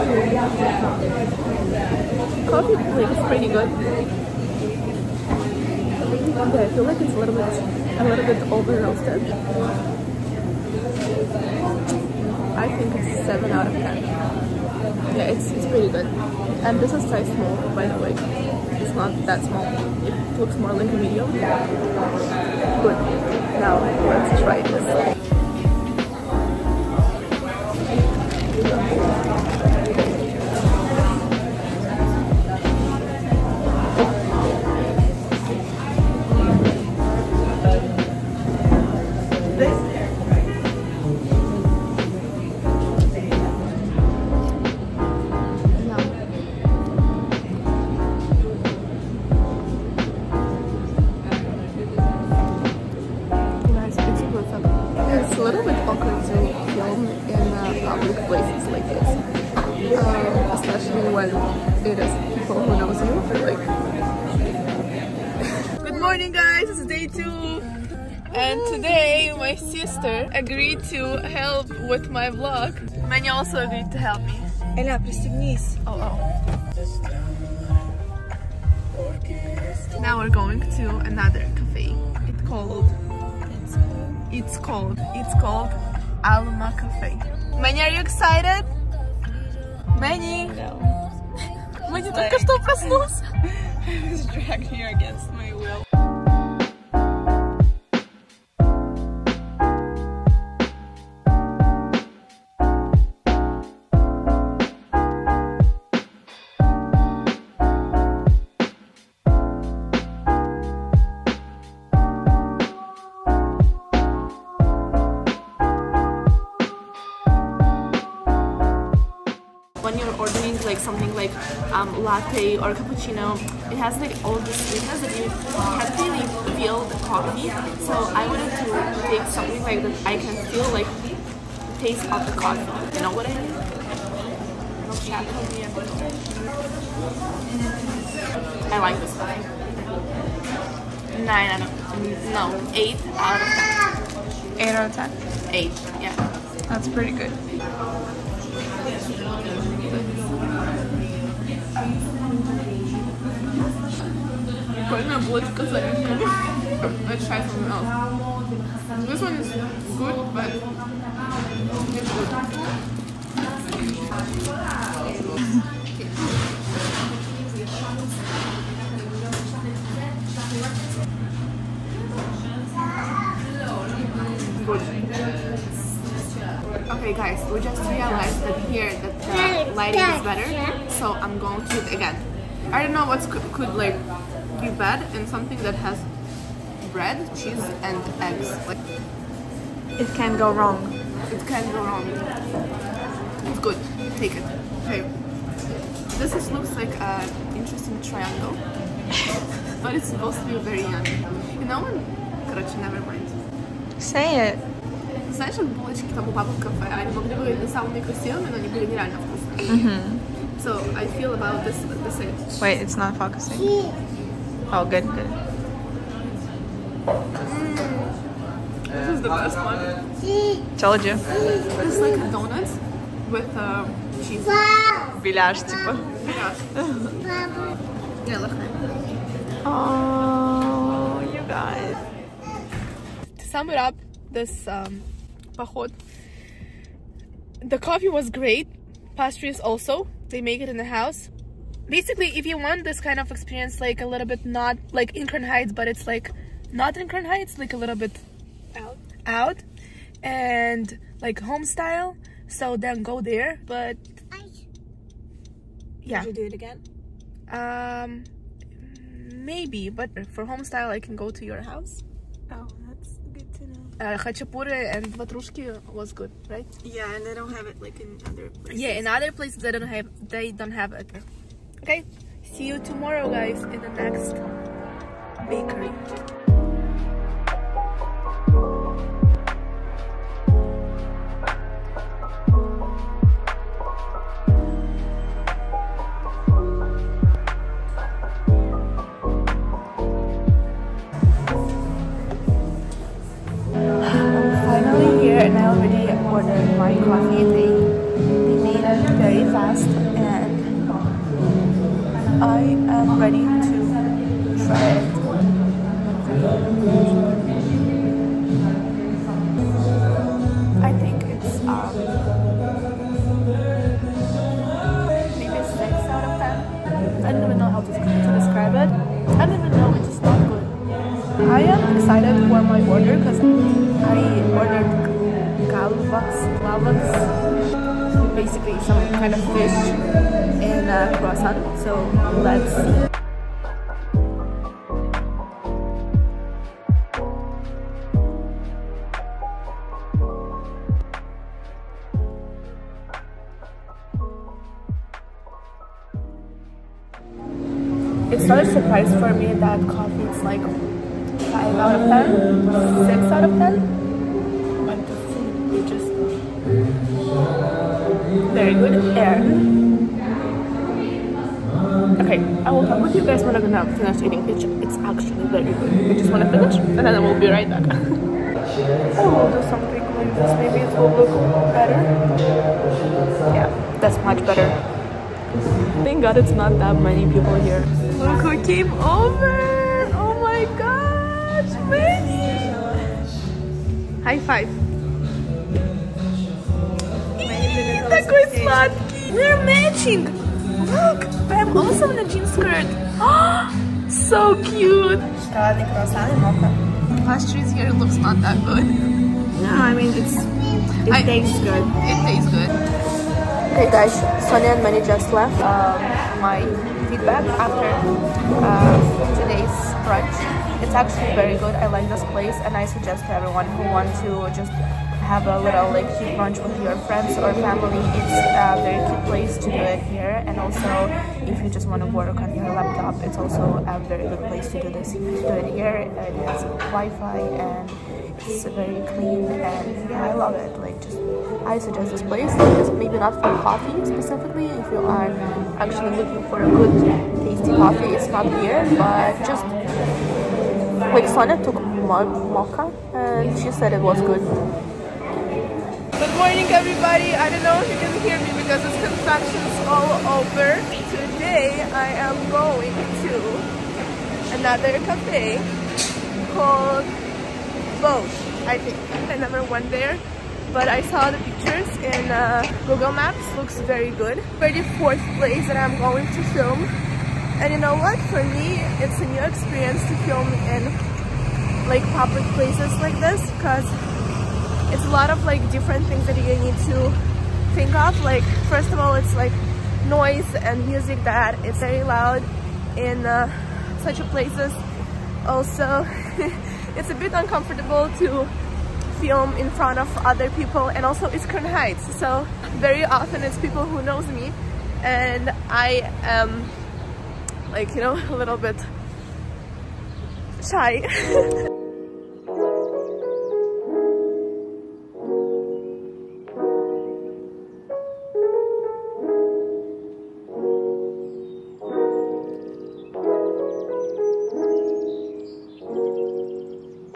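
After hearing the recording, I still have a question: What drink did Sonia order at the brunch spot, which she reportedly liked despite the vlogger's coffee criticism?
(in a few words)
Mocha.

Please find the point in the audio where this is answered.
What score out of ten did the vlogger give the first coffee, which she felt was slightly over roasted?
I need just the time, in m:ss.
0:13.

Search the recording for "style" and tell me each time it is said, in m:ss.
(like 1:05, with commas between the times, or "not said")
4:11, 4:20.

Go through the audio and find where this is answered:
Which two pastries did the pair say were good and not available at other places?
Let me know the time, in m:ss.
4:24.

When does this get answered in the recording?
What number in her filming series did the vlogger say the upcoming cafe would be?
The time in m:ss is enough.
7:44.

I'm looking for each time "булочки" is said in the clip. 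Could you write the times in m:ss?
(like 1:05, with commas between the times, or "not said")
3:25.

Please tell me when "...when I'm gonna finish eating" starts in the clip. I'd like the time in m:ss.
6:03.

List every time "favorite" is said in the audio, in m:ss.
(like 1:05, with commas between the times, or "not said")
not said.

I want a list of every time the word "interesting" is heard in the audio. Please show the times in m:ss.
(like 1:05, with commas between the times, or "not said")
3:17.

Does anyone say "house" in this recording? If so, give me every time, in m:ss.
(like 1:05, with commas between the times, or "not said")
4:00, 4:21.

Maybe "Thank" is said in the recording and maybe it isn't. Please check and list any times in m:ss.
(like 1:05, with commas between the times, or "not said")
6:16.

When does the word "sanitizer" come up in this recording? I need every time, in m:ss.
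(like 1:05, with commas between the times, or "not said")
not said.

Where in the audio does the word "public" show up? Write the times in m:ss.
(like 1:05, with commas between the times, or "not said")
7:52.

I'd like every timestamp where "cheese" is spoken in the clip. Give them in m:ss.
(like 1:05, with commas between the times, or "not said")
3:07, 3:44.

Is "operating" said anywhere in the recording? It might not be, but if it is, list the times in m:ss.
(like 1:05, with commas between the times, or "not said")
not said.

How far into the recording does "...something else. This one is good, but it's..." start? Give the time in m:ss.
2:37.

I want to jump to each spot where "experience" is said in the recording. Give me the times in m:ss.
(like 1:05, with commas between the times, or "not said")
4:03, 7:49.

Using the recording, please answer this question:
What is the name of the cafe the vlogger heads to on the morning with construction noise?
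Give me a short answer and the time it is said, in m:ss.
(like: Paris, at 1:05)
Bosch, at 7:38.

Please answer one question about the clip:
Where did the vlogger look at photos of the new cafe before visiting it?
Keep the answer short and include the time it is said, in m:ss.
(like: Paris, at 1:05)
Google Maps, at 7:42.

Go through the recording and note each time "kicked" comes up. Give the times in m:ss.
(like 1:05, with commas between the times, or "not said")
not said.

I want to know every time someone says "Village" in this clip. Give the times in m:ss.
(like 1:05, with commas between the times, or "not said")
3:45.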